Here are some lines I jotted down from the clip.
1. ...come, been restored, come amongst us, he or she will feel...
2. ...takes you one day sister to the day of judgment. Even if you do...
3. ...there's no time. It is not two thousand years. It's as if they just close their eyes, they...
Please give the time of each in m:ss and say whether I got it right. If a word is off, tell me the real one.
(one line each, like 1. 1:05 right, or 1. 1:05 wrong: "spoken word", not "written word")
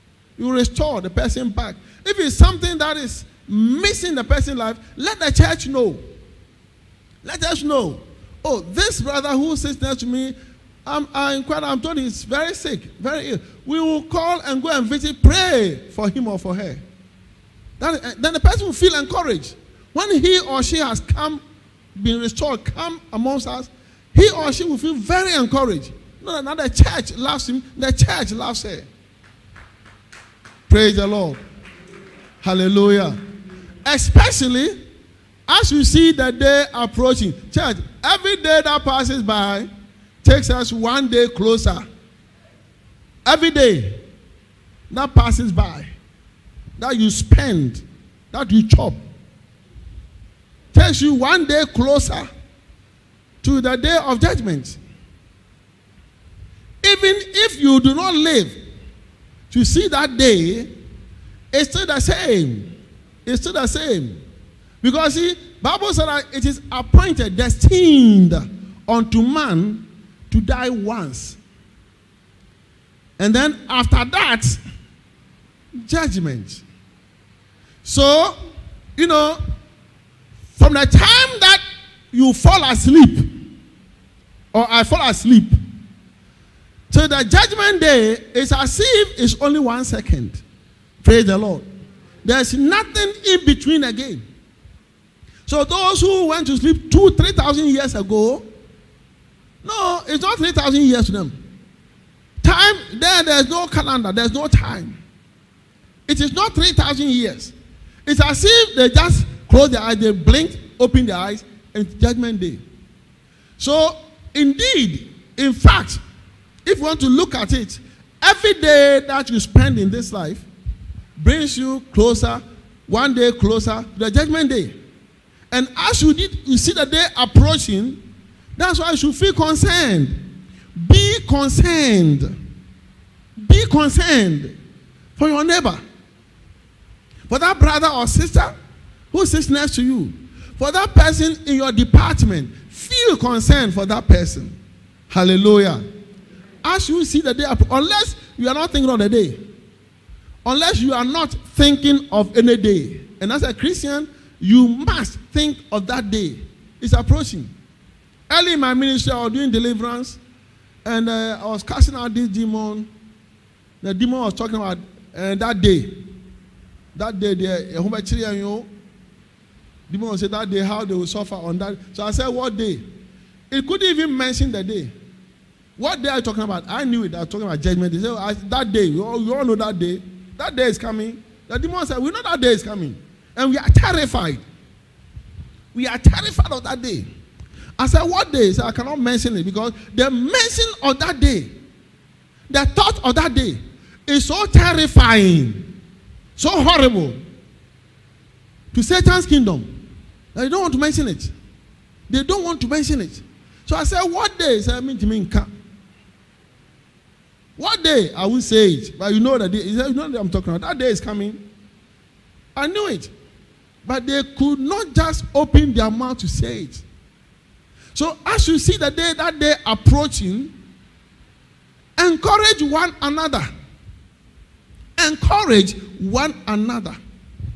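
1. 0:21 right
2. 0:50 wrong: "closer", not "sister"
3. 1:44 wrong: "three", not "two".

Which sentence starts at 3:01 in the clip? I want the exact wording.
The demon said, We know that day is coming.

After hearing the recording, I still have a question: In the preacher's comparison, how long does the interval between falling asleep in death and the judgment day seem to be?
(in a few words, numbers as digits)
One second.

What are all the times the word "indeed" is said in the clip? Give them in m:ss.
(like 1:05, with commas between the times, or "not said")
1:54.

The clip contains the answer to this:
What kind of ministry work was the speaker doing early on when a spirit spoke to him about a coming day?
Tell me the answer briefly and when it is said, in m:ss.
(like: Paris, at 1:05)
Deliverance, at 2:39.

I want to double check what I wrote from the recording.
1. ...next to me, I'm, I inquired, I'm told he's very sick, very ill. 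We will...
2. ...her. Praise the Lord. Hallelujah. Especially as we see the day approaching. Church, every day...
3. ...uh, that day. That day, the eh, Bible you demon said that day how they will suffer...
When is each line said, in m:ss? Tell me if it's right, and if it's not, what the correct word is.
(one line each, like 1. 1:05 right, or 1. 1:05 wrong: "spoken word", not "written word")
1. 0:09 right
2. 0:28 right
3. 2:45 wrong: "Humber", not "Bible".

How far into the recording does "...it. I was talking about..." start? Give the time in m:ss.
2:57.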